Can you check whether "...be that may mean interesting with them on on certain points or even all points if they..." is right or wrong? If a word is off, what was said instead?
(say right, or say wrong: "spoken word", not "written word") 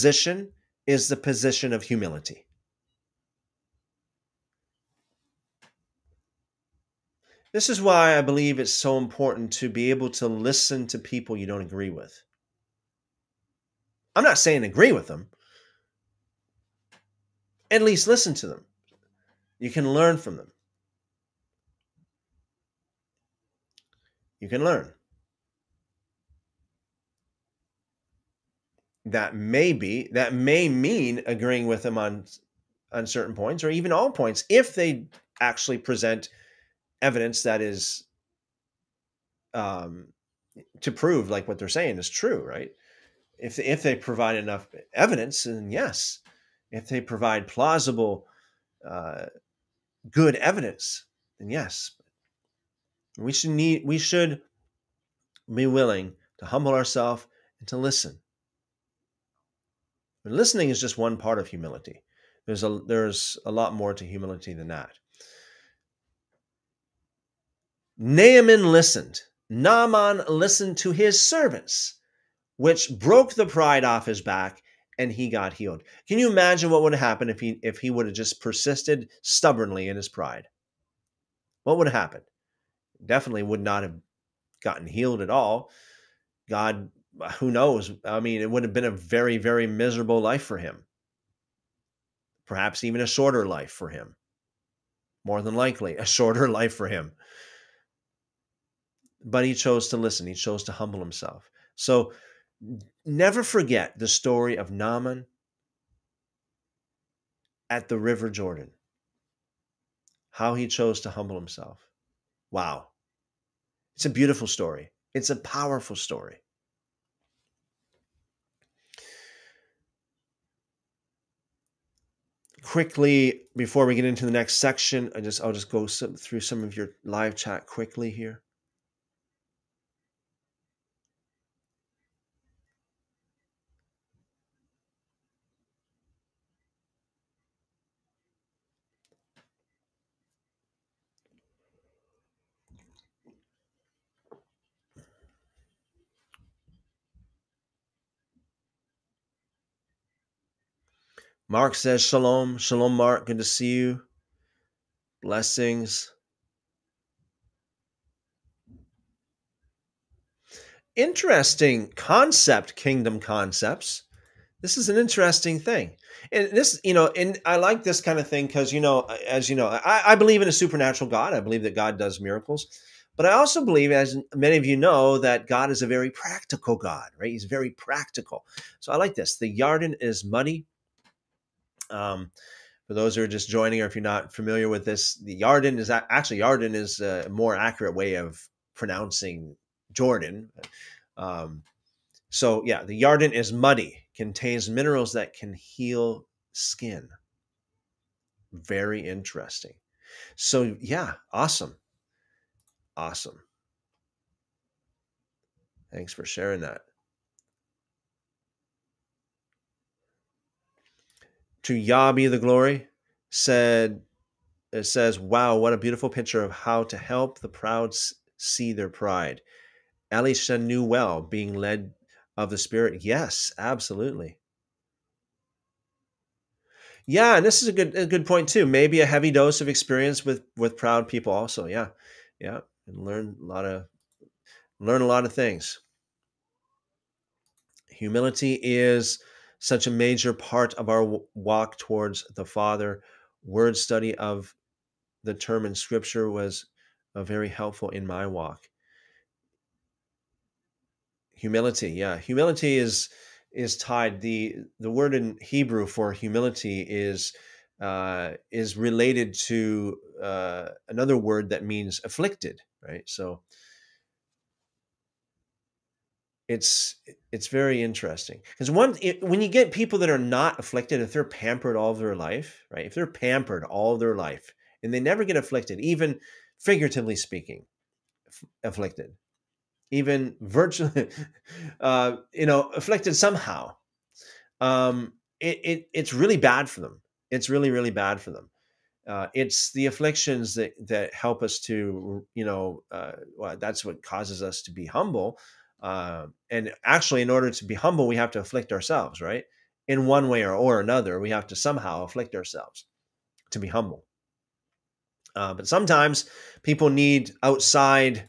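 wrong: "agreeing", not "interesting".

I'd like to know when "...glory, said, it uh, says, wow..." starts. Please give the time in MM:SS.
03:32.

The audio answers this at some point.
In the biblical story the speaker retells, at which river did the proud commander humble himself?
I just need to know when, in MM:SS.
01:47.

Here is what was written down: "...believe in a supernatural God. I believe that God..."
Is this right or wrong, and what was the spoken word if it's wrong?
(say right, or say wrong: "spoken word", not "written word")
right.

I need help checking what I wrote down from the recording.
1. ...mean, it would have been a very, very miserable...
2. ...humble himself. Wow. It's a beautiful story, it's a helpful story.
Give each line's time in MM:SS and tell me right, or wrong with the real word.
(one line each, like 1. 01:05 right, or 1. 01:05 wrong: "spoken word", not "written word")
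1. 01:28 right
2. 01:51 wrong: "powerful", not "helpful".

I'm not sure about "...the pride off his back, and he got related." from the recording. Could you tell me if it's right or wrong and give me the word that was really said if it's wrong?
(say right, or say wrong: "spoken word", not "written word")
wrong: "healed", not "related".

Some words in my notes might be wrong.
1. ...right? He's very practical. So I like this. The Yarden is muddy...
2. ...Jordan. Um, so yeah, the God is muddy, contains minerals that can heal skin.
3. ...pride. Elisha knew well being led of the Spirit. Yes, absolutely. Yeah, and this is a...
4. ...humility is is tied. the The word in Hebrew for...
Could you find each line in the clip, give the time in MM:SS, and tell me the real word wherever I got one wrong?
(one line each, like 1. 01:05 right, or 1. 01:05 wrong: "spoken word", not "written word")
1. 02:57 right
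2. 03:09 wrong: "Yarden", not "God"
3. 03:38 right
4. 04:12 right.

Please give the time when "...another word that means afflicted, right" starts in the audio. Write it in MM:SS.
04:20.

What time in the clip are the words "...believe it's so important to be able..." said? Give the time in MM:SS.
00:08.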